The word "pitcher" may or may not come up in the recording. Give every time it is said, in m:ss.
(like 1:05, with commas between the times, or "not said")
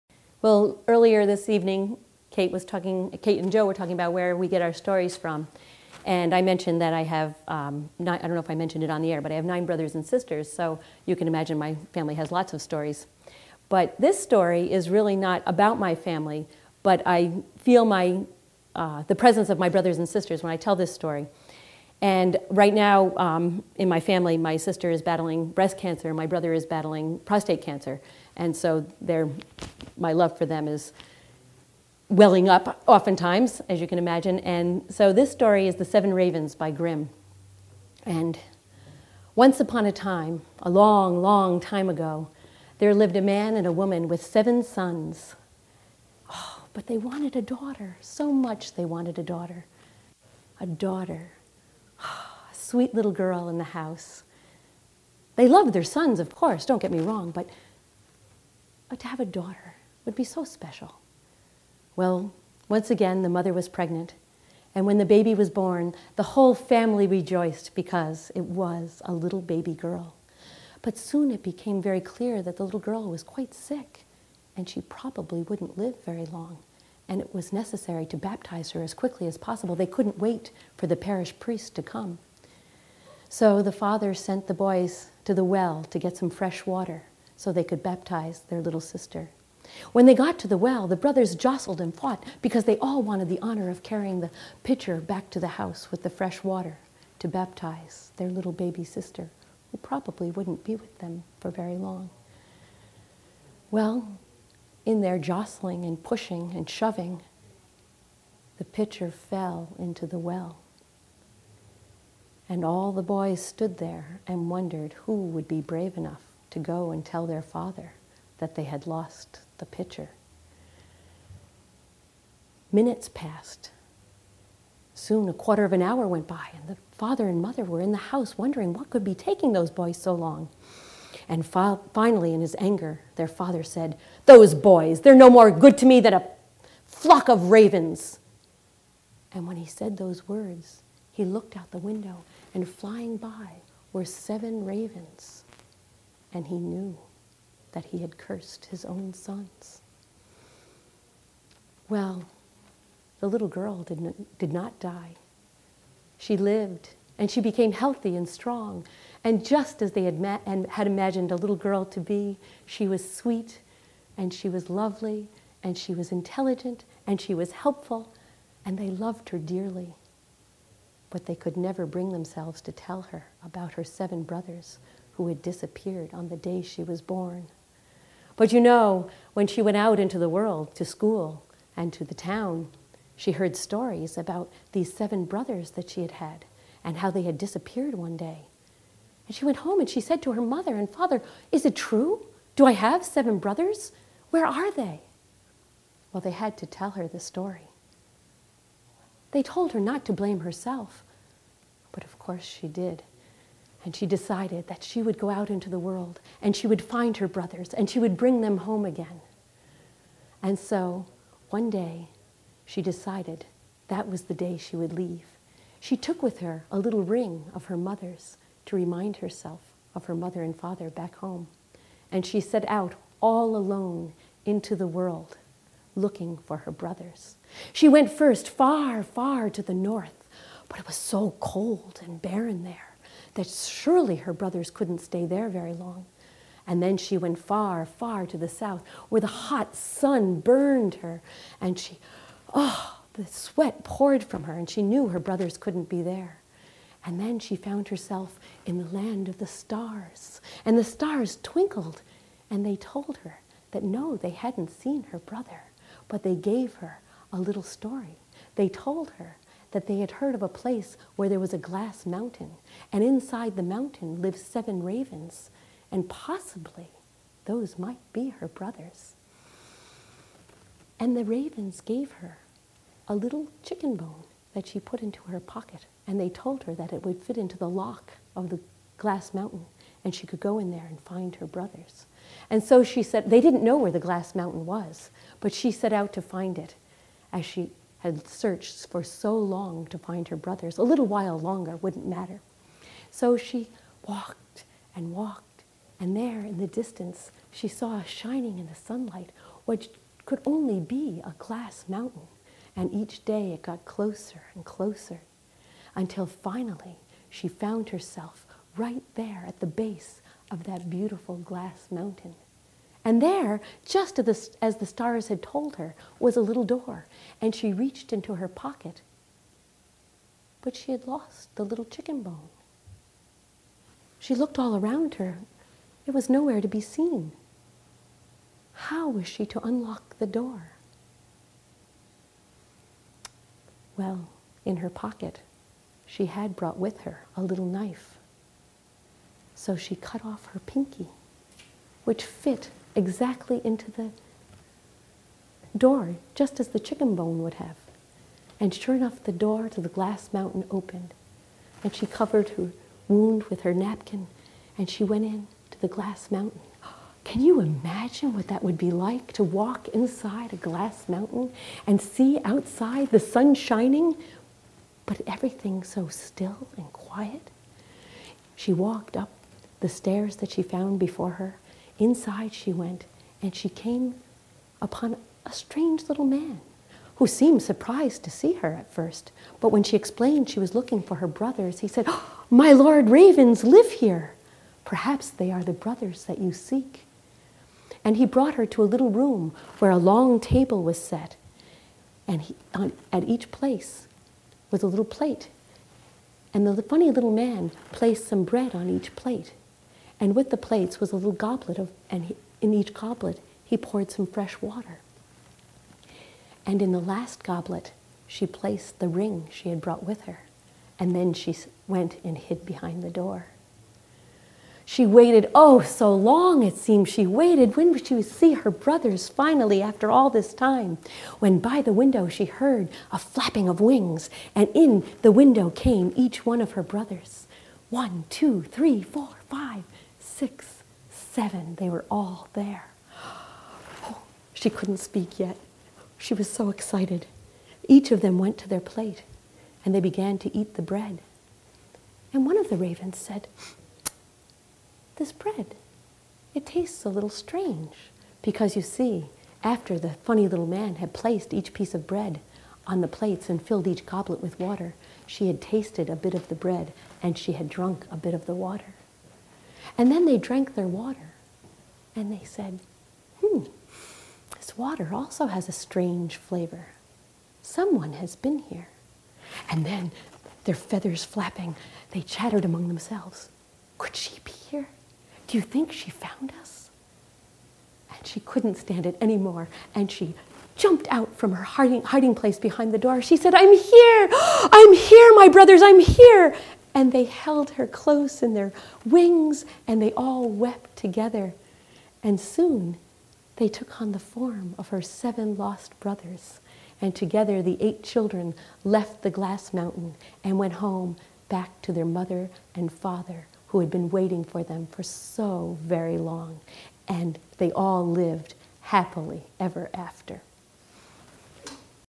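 1:34, 1:48, 1:59.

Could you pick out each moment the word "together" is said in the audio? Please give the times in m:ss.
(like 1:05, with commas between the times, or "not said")
8:10, 8:17.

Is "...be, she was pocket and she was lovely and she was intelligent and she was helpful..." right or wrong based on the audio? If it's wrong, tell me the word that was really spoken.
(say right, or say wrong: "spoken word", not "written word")
wrong: "sweet", not "pocket".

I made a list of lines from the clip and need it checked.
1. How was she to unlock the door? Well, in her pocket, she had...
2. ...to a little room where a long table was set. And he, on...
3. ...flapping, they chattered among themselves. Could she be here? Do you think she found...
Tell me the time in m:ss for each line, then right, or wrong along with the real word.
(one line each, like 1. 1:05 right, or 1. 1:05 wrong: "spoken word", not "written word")
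1. 5:28 right
2. 6:28 right
3. 7:51 right.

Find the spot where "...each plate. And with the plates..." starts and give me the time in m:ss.
6:38.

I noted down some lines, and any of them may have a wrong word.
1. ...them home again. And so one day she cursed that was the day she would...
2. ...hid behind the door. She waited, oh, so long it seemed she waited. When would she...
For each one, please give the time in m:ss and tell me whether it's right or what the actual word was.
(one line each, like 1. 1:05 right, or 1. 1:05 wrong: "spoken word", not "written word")
1. 3:28 wrong: "decided", not "cursed"
2. 6:52 right.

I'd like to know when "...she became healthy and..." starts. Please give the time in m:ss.
2:37.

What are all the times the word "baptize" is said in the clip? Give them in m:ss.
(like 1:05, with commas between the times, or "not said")
1:18, 1:27, 1:37.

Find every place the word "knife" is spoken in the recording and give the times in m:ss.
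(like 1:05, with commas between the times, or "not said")
5:37.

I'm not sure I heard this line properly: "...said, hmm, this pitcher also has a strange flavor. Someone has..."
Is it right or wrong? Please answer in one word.
wrong.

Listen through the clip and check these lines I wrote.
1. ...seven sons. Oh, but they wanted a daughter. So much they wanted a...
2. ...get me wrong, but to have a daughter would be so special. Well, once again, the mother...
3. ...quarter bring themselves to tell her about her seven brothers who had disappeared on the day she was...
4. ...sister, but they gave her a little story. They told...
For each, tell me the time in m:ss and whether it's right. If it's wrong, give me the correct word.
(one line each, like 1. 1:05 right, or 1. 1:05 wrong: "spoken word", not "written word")
1. 0:44 right
2. 0:56 right
3. 2:51 wrong: "never", not "quarter"
4. 4:15 wrong: "brother", not "sister".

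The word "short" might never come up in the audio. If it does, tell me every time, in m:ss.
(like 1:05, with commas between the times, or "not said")
not said.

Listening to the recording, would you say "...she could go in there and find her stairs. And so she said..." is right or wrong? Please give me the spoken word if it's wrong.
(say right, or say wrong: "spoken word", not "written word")
wrong: "brothers", not "stairs".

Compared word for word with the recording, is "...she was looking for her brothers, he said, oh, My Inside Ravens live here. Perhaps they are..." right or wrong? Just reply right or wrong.
wrong.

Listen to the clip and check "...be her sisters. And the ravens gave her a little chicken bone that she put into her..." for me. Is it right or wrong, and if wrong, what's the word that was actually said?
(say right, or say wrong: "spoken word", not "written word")
wrong: "brothers", not "sisters".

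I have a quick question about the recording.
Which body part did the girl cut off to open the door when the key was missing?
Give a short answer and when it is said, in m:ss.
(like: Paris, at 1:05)
her pinky, at 5:40.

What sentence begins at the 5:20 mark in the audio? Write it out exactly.
But she had lost the little chicken bone.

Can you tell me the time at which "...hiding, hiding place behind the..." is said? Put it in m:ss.
8:01.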